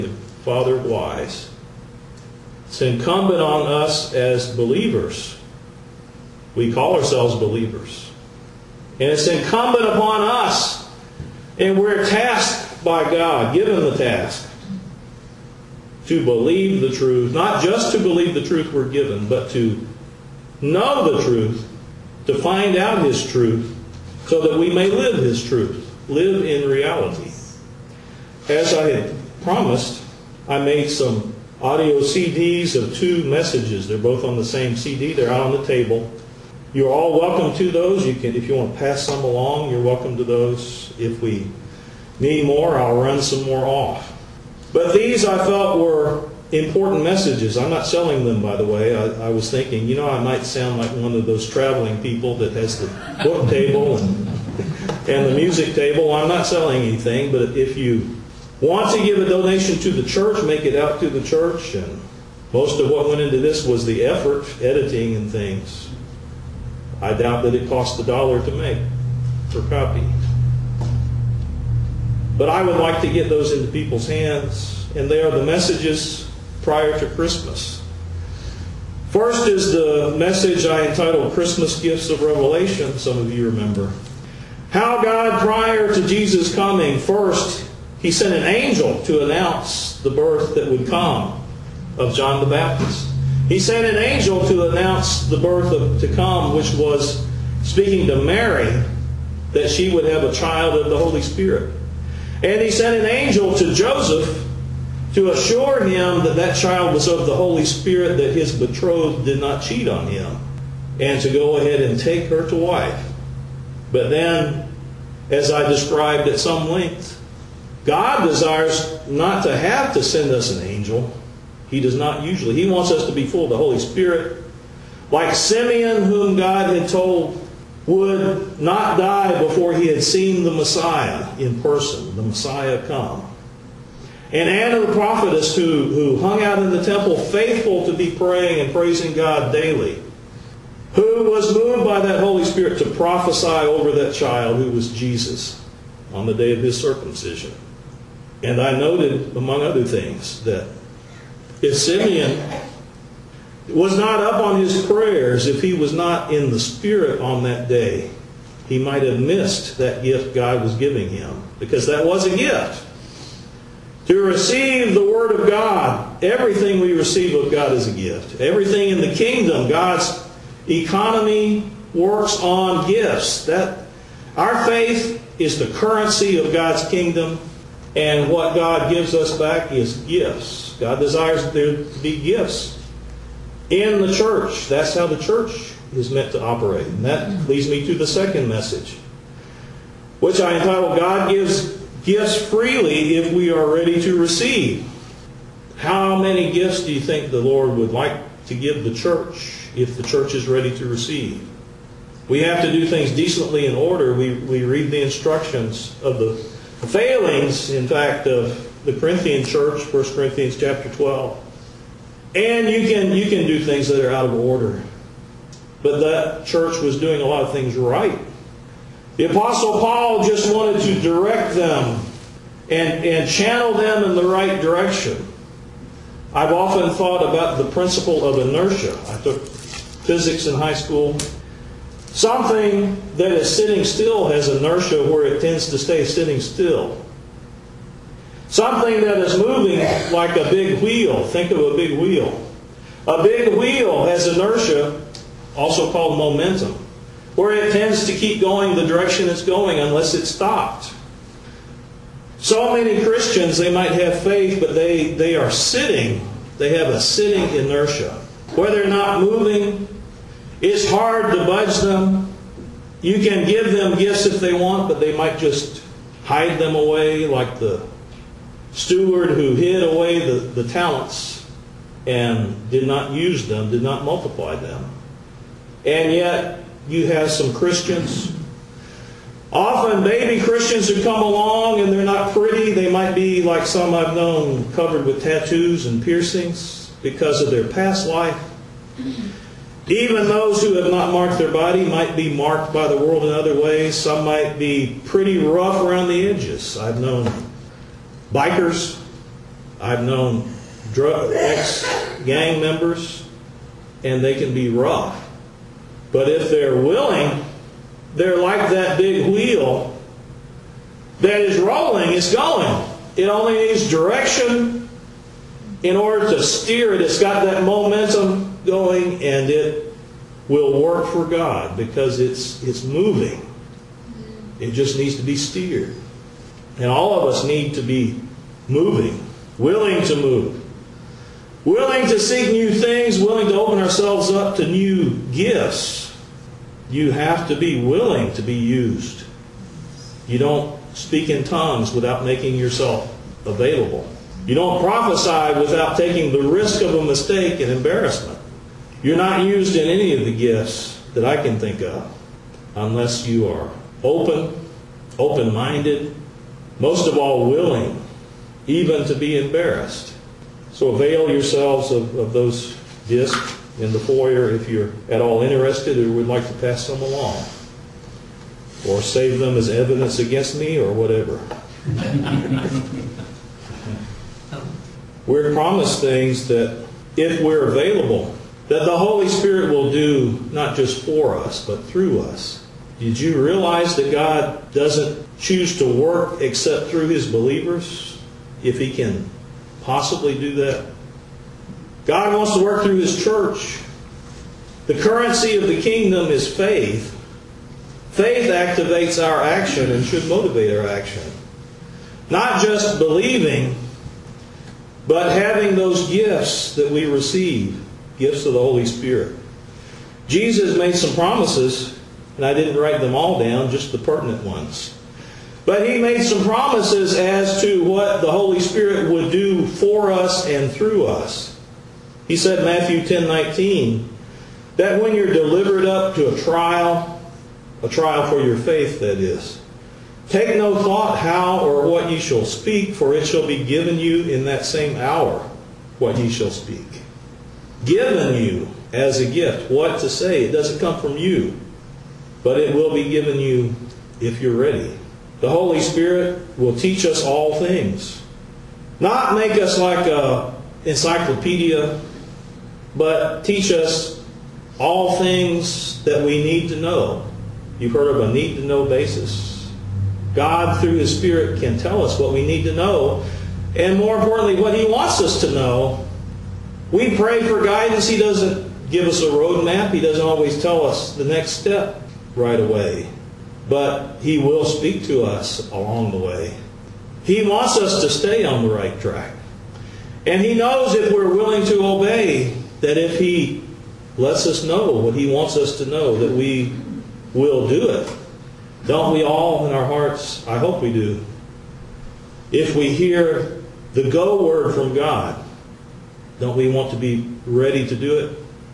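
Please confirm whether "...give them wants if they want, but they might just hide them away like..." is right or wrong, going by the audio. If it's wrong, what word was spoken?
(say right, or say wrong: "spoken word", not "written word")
wrong: "gifts", not "wants".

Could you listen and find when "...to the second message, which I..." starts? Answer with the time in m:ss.
3:07.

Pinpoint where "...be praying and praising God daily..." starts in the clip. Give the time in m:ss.
2:17.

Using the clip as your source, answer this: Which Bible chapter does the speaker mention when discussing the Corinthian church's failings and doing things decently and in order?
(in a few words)
1 Corinthians 12.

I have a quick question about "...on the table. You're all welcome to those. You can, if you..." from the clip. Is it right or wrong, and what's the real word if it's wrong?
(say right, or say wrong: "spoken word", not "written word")
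right.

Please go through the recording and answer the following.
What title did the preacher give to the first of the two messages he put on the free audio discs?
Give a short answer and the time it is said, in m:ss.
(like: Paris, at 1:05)
Christmas Gifts of Revelation, at 1:21.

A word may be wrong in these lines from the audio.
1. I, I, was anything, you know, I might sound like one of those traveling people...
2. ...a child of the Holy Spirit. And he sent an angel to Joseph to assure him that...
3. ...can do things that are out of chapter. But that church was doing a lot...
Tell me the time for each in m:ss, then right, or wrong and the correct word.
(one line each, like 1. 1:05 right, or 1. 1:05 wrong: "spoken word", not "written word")
1. 0:48 wrong: "thinking", not "anything"
2. 1:40 right
3. 3:33 wrong: "order", not "chapter".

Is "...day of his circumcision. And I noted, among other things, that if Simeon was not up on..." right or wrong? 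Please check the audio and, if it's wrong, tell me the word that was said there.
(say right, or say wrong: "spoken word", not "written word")
right.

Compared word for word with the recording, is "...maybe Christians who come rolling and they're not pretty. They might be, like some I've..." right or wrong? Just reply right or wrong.
wrong.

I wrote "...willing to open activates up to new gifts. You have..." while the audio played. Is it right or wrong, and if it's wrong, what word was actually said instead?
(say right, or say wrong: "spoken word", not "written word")
wrong: "ourselves", not "activates".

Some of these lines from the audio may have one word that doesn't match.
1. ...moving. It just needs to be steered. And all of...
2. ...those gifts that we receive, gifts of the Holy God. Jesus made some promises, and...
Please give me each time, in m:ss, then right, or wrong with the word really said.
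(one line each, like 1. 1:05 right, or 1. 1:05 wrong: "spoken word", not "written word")
1. 5:22 right
2. 6:45 wrong: "Spirit", not "God".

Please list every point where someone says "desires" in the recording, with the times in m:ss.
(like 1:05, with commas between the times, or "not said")
1:58, 3:00.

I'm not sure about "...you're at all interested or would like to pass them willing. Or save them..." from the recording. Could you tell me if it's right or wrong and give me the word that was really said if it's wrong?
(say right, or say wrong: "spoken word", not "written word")
wrong: "along", not "willing".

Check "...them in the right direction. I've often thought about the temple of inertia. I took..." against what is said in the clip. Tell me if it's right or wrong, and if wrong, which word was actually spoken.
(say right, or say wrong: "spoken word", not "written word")
wrong: "principle", not "temple".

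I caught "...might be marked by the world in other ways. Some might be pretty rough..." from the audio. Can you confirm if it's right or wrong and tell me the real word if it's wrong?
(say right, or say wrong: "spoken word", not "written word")
right.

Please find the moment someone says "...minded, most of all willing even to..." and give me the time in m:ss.
5:55.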